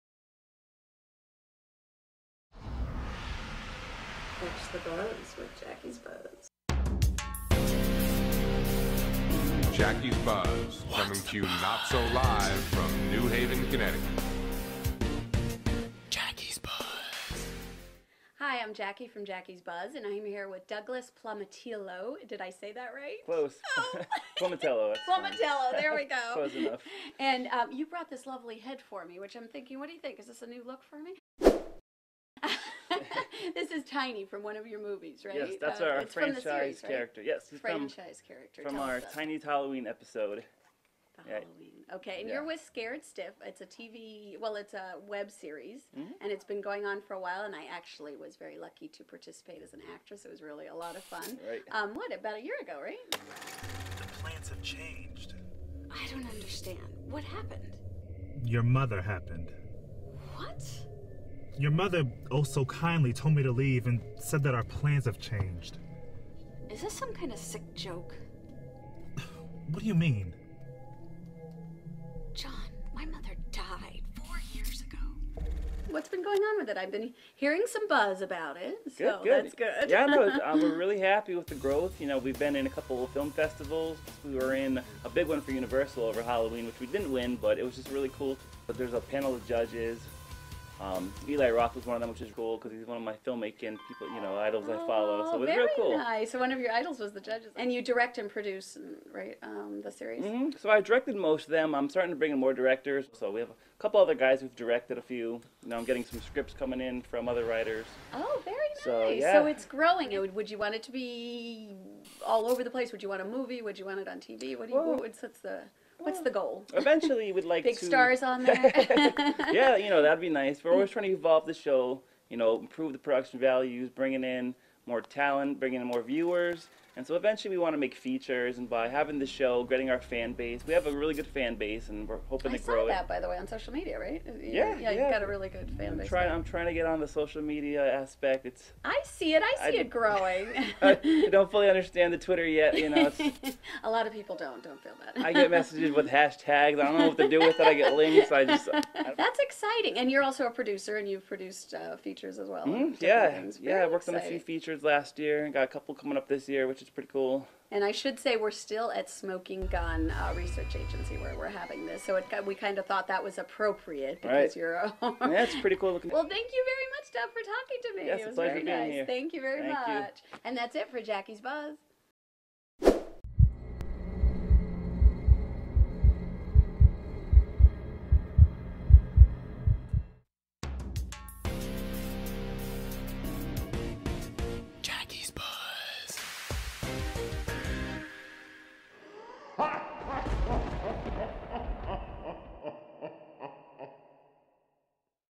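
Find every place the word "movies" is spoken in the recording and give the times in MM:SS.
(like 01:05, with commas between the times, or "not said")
00:34, 01:53.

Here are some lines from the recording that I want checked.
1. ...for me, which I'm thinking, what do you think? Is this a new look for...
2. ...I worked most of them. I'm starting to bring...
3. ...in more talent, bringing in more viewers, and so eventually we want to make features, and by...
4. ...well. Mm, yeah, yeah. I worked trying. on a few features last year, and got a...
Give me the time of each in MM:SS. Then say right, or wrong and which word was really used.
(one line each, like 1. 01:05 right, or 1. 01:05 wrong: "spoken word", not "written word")
1. 00:28 right
2. 01:40 wrong: "directed", not "worked"
3. 02:04 right
4. 02:32 wrong: "exciting", not "trying".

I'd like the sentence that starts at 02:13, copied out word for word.
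by the way, on social media, right?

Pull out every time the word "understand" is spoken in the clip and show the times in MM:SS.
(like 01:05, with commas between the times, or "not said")
00:56, 02:21.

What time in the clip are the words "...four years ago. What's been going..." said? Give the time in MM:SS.
01:14.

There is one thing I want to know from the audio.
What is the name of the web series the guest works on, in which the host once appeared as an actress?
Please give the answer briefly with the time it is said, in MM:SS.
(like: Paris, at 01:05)
Scared Stiff, at 00:42.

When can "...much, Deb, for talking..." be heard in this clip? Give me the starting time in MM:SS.
02:46.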